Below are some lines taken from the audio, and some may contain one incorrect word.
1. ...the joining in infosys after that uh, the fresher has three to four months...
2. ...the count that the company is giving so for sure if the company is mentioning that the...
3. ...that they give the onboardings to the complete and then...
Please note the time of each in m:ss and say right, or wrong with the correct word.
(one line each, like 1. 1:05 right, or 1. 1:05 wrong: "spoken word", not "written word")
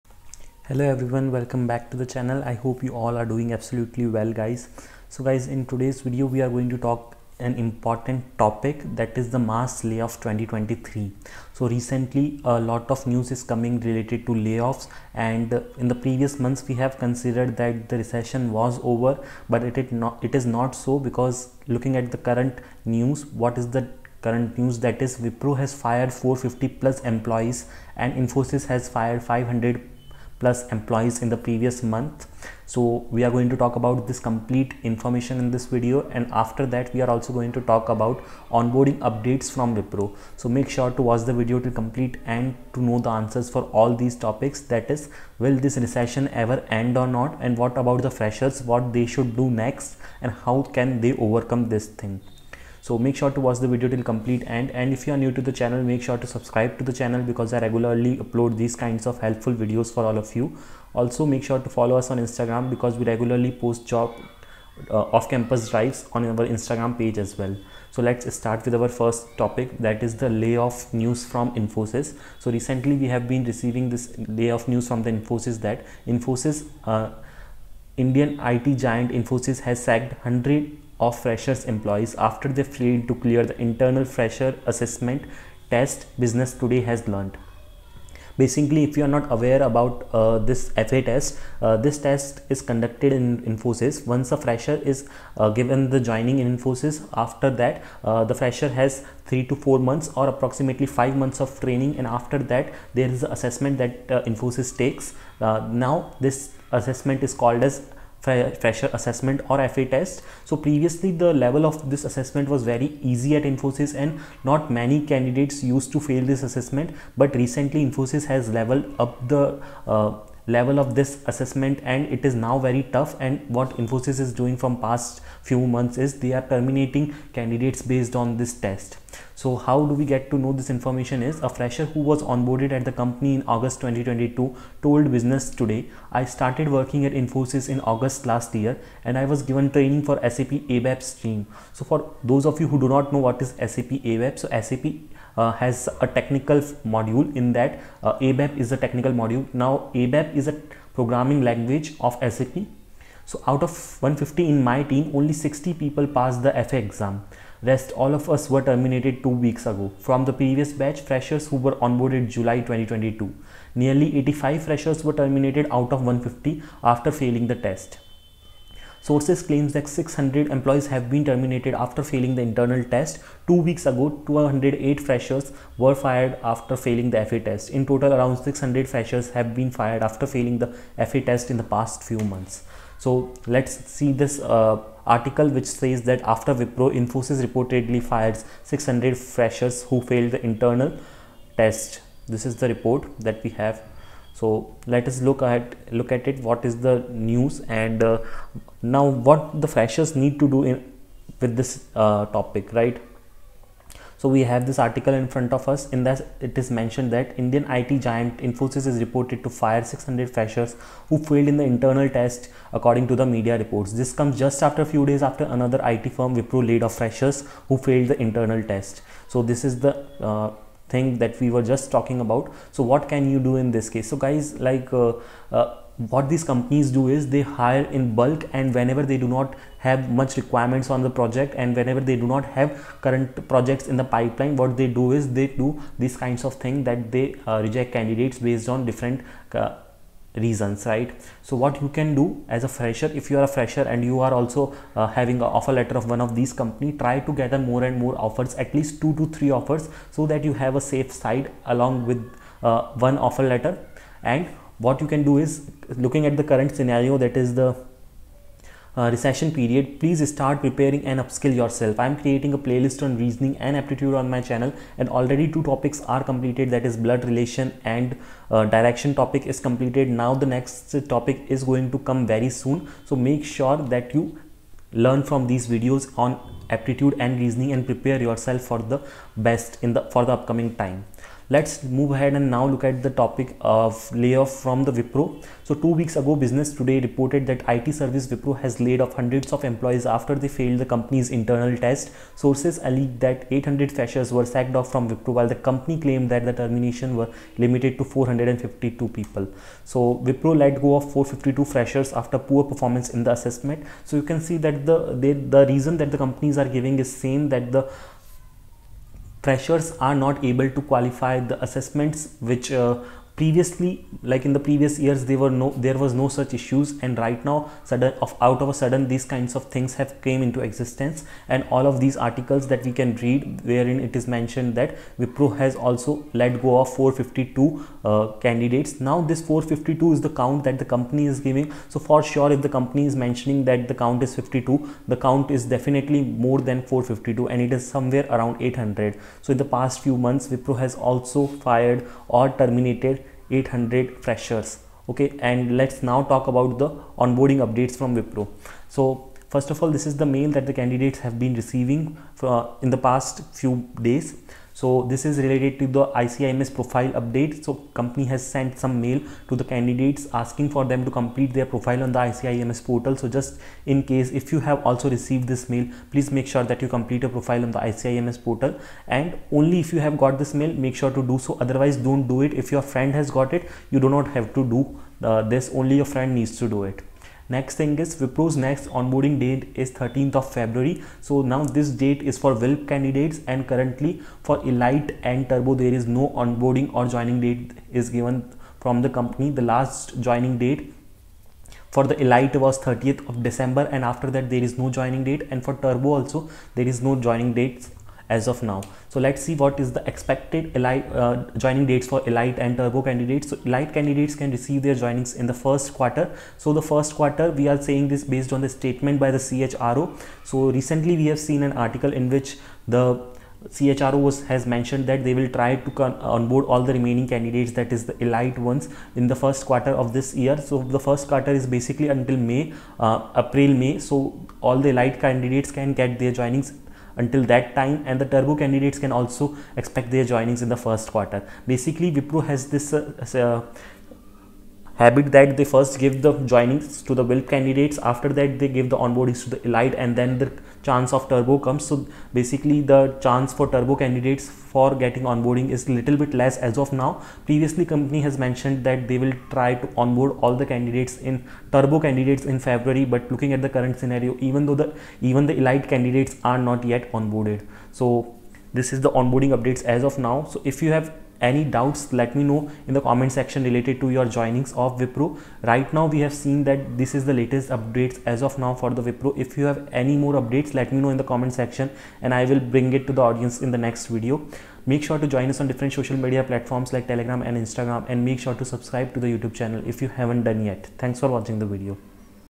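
1. 1:35 right
2. 5:30 right
3. 7:18 wrong: "elite", not "complete".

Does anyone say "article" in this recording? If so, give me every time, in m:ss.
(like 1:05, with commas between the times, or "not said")
3:05, 3:24, 5:22, 6:51.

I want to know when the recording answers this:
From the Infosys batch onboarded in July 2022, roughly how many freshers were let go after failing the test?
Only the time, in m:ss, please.
2:43.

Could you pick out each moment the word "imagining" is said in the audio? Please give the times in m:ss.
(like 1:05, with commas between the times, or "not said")
not said.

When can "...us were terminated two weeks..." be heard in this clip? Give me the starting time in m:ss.
2:38.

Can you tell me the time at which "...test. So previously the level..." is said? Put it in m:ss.
1:49.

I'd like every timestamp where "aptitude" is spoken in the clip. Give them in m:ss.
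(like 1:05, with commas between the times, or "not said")
4:23, 4:36.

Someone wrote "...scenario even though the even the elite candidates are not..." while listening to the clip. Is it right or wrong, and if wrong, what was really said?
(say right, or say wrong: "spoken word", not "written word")
right.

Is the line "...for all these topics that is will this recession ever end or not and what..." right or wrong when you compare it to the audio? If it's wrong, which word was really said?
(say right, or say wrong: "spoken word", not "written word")
right.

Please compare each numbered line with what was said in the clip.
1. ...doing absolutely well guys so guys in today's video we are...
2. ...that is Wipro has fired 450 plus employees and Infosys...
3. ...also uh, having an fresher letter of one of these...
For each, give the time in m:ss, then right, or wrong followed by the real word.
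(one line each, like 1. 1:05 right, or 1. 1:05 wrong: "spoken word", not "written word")
1. 0:03 right
2. 0:24 right
3. 4:04 wrong: "offer", not "fresher".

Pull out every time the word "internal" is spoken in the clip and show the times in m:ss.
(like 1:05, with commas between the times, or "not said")
1:23, 2:52, 3:10, 3:31, 3:38, 4:51.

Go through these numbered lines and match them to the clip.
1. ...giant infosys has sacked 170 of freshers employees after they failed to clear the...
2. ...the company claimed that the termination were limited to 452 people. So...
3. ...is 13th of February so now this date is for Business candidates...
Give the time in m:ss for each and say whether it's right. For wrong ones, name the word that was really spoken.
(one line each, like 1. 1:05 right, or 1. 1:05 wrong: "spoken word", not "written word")
1. 1:18 wrong: "100", not "170"
2. 4:55 right
3. 6:19 wrong: "WILP", not "Business".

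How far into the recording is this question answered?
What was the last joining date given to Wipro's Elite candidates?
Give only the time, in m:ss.
6:32.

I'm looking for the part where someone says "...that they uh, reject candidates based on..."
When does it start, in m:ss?
3:56.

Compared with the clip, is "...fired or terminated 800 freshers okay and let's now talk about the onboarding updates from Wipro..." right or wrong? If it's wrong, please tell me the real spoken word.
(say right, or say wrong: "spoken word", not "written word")
right.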